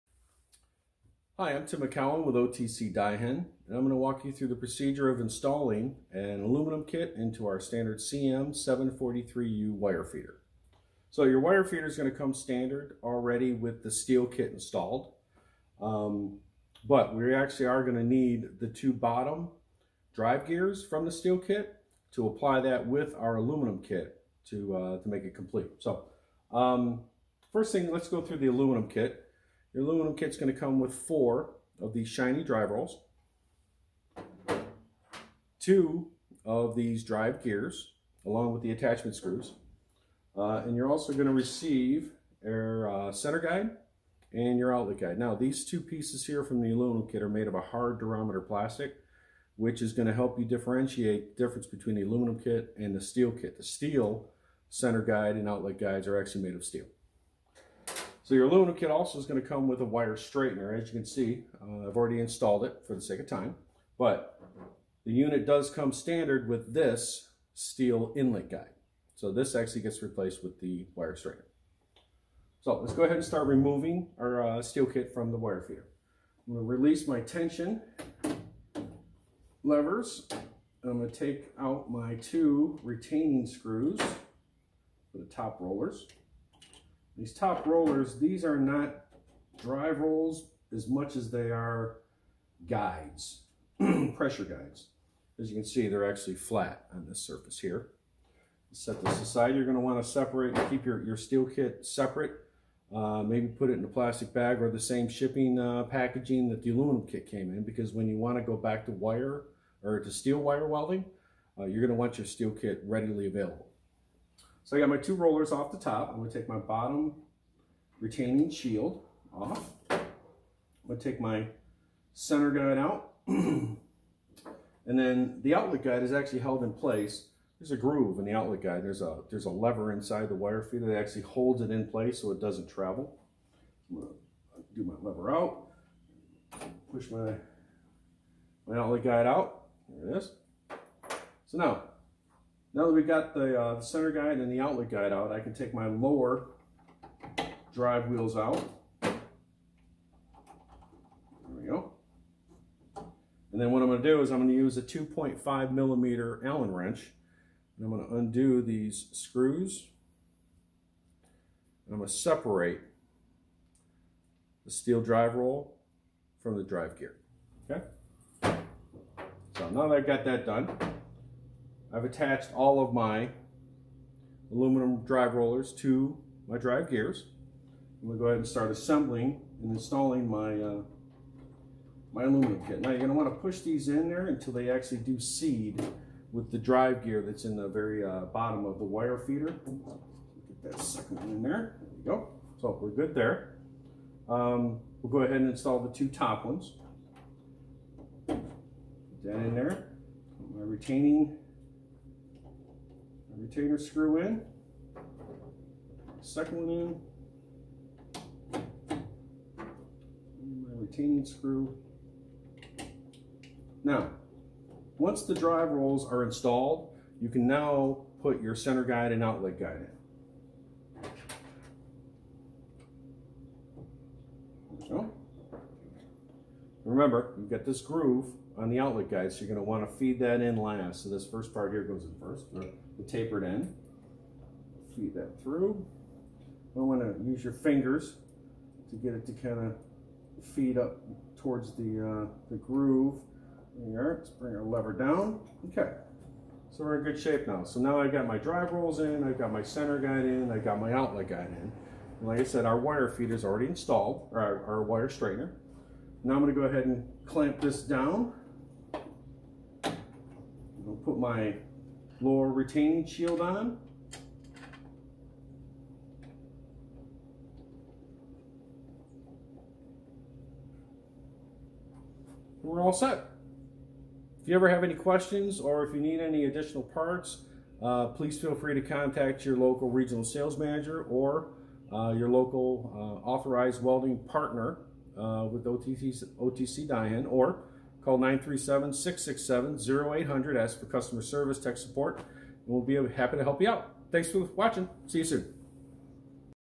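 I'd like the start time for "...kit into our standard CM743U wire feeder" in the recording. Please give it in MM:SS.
00:06.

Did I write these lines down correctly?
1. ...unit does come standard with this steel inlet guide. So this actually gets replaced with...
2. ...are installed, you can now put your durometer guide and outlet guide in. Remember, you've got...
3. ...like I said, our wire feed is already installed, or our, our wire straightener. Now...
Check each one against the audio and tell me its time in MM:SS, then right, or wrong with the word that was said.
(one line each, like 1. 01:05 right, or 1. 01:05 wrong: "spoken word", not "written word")
1. 01:05 right
2. 03:36 wrong: "center", not "durometer"
3. 04:12 right.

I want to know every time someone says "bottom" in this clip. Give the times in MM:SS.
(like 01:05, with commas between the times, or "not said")
00:18, 01:56, 03:08.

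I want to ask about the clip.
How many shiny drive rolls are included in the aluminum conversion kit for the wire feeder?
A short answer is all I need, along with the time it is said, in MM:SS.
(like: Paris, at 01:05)
4, at 00:30.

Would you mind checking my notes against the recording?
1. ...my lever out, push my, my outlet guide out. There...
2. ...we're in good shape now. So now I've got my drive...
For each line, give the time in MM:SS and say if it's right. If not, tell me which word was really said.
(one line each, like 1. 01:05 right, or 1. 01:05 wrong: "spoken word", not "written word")
1. 02:14 right
2. 04:06 right.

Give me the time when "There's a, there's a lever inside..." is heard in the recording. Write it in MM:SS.
02:08.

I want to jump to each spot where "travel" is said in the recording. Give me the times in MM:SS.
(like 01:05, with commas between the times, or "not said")
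02:12.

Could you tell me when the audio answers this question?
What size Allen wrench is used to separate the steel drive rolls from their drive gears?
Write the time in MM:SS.
02:34.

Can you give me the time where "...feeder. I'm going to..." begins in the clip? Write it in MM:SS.
01:15.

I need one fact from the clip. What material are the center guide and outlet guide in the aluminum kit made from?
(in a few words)
Hard durometer plastic.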